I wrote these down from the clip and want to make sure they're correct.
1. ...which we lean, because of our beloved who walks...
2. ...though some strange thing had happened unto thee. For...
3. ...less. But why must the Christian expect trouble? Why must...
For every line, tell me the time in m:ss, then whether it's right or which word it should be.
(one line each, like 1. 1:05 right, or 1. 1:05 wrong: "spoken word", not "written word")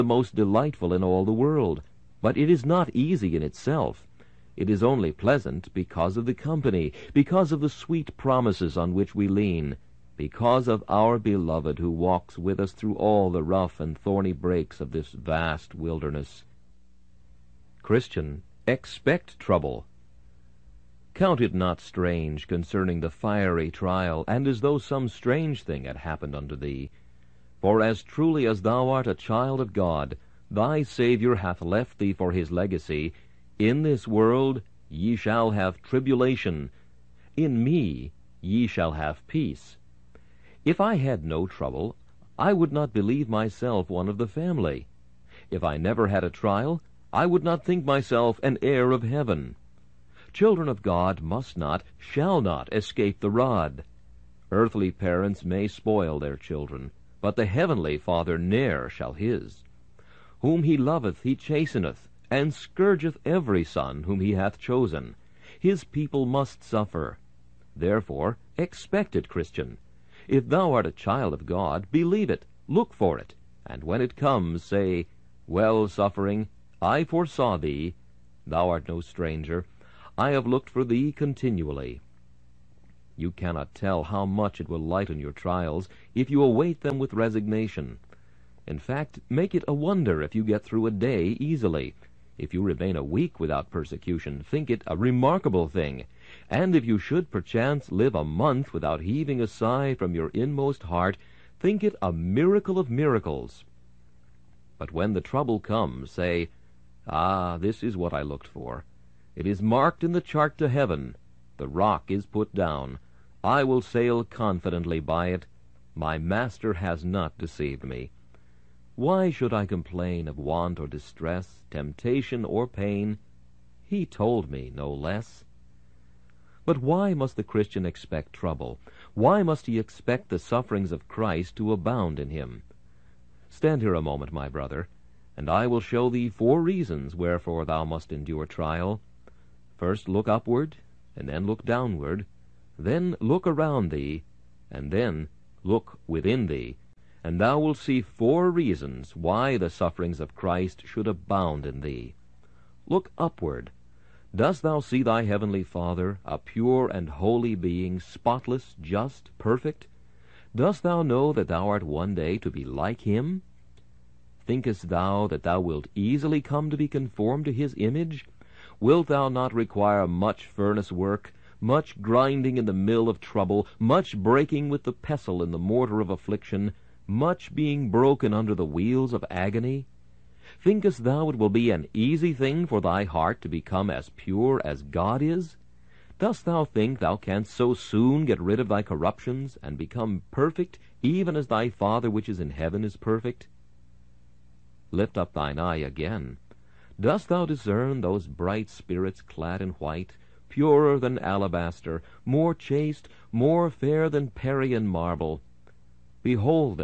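1. 0:08 right
2. 0:24 right
3. 2:04 right.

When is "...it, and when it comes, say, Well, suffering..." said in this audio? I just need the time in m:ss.
1:13.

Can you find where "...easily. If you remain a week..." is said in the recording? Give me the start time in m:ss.
1:31.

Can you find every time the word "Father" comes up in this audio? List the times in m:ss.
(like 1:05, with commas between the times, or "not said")
0:57, 2:35, 3:11.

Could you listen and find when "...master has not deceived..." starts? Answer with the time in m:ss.
1:56.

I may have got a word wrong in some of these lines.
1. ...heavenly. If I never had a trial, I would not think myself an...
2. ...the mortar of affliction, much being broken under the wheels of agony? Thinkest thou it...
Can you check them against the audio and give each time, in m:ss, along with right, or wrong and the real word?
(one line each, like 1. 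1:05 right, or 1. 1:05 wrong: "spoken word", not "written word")
1. 0:44 wrong: "family", not "heavenly"
2. 2:55 right.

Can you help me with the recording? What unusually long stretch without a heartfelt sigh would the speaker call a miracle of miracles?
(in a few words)
a month.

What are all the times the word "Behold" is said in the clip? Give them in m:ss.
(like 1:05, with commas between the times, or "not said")
3:26.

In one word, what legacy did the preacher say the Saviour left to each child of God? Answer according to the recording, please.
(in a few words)
tribulation.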